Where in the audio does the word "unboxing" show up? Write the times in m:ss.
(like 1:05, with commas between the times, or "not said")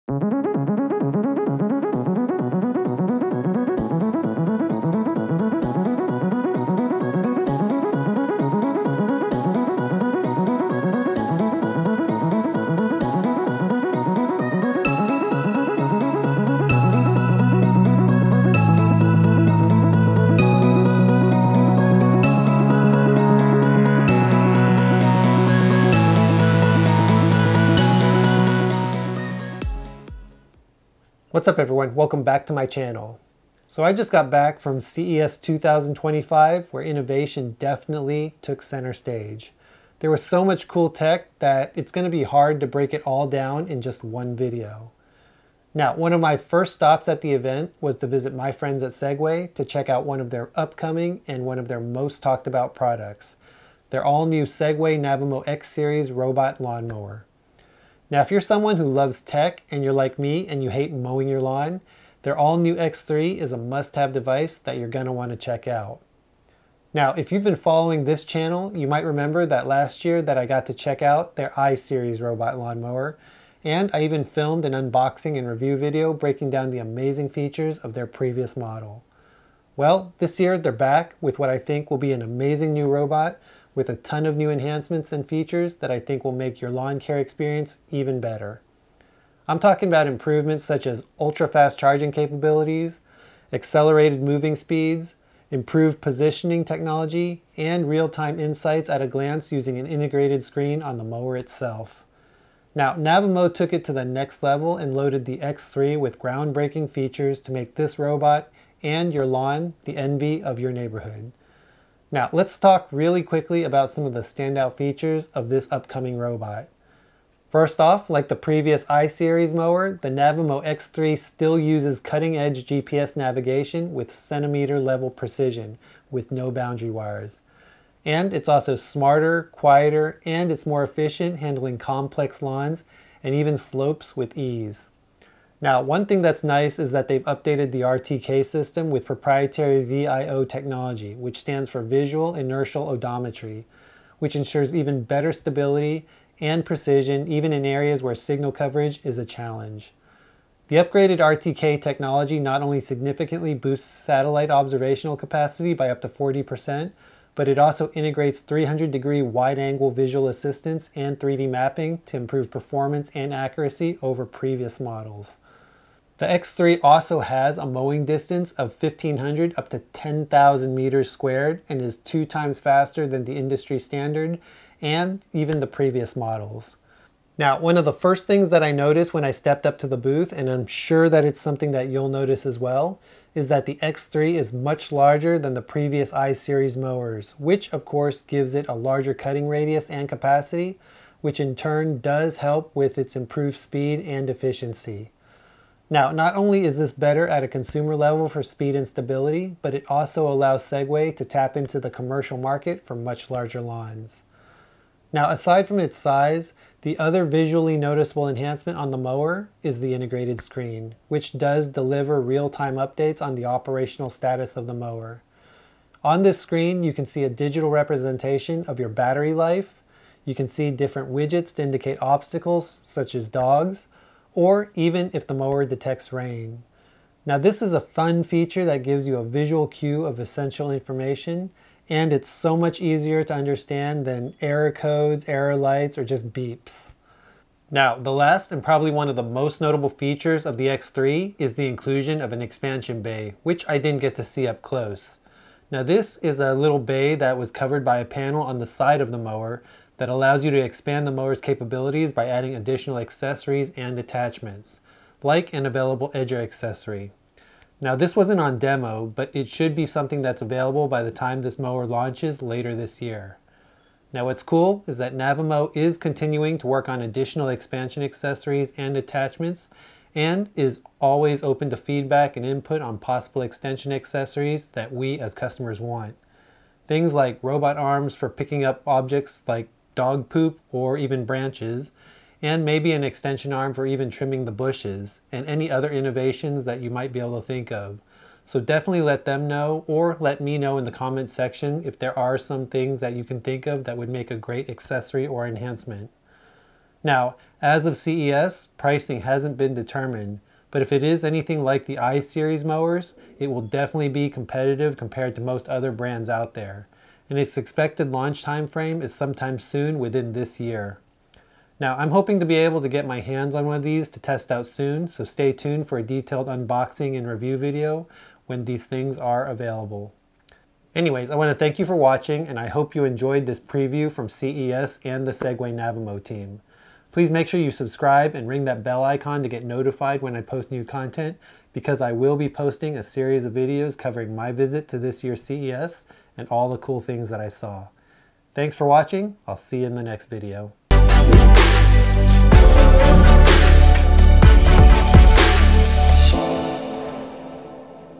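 1:14, 5:16.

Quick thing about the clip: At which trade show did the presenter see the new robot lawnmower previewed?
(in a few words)
CES 2025.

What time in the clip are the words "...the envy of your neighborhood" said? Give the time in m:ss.
1:49.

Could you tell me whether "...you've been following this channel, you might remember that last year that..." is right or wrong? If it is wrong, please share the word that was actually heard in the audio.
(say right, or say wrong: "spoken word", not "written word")
right.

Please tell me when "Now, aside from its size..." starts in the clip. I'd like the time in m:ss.
3:25.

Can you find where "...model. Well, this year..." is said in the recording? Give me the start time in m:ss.
1:18.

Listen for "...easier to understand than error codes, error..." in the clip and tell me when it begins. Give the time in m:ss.
3:52.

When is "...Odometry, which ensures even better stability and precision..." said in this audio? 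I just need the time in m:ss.
2:22.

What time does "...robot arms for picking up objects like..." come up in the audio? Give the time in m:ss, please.
4:37.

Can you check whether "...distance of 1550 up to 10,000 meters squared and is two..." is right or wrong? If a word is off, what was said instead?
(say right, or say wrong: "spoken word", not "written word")
wrong: "1500", not "1550".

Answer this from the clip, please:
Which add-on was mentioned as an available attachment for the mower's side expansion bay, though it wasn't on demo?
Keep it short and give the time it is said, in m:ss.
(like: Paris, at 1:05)
Edger accessory, at 4:16.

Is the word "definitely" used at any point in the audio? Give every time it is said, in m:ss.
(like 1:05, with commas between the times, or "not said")
0:37, 4:48, 5:03.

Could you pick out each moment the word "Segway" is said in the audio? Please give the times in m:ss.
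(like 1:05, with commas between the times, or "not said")
0:48, 0:54, 3:20, 5:25.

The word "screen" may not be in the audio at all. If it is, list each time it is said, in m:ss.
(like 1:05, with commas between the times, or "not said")
1:40, 3:30, 3:36.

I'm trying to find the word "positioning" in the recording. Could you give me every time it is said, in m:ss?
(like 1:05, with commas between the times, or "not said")
1:35.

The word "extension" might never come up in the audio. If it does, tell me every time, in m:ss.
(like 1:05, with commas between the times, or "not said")
4:33, 4:43.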